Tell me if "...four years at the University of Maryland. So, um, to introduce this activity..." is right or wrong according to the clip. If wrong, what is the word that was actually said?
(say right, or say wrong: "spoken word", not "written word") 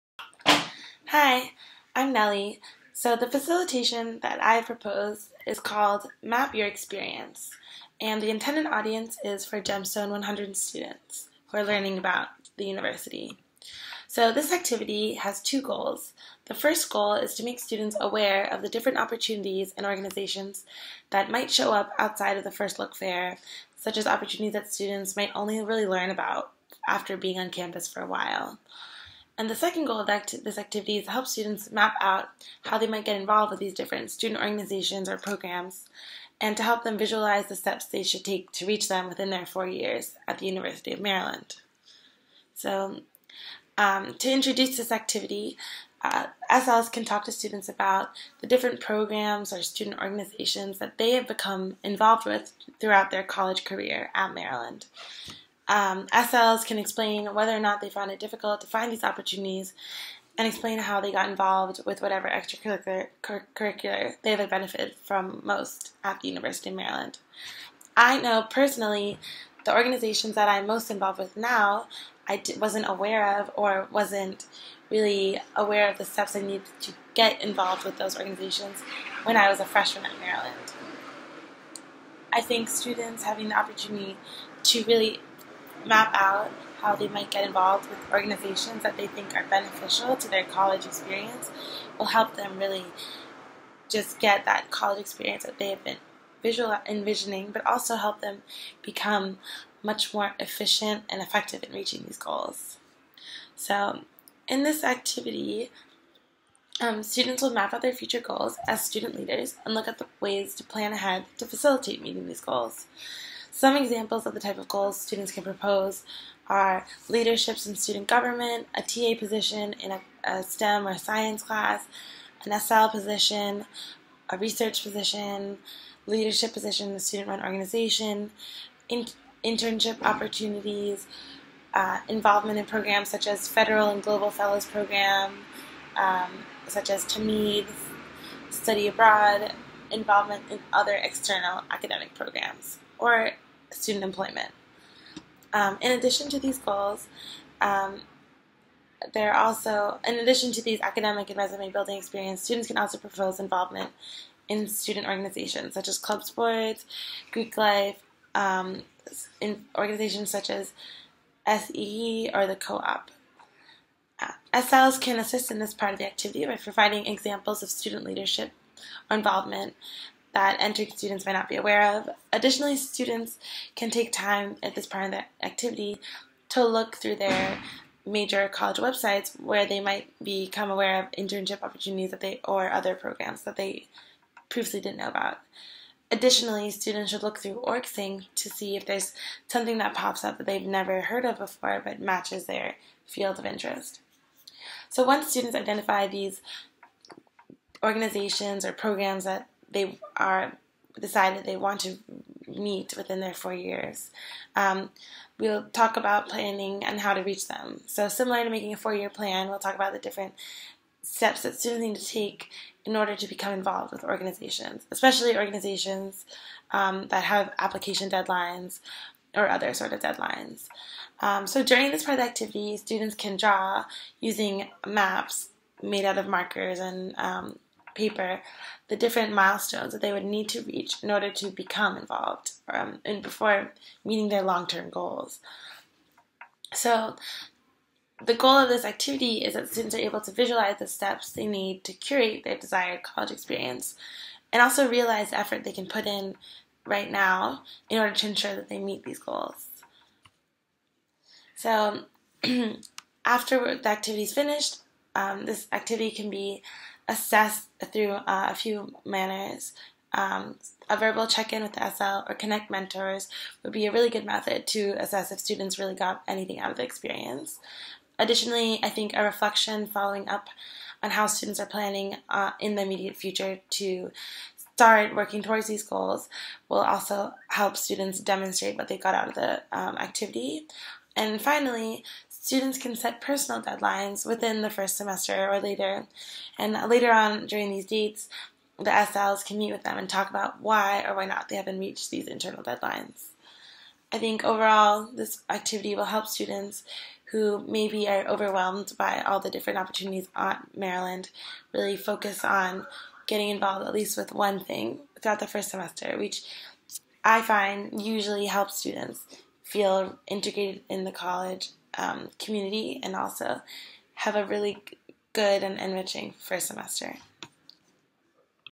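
right.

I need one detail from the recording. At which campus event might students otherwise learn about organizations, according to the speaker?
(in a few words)
First Look Fair.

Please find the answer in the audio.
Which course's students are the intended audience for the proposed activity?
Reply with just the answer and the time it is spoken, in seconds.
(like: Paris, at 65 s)
Gemstone 100, at 9 s.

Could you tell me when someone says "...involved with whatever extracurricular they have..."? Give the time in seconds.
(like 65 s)
61 s.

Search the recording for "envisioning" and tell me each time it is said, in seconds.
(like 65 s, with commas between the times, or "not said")
96 s.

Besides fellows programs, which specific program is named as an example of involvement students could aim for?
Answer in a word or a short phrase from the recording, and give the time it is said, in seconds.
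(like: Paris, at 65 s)
TAMID, at 137 s.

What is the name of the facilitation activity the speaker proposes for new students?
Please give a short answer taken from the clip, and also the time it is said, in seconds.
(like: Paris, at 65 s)
Map Your Experience, at 6 s.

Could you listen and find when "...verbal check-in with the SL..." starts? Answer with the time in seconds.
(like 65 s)
260 s.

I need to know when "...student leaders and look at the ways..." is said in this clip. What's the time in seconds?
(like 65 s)
108 s.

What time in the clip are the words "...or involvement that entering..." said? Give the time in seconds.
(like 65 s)
169 s.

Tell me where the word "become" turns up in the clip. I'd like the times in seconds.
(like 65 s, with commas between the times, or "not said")
51 s, 98 s, 180 s, 213 s, 231 s.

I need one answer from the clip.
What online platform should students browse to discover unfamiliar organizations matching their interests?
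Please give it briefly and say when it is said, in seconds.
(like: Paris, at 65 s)
OrgSync, at 187 s.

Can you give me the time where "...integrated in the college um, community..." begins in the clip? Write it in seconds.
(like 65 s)
310 s.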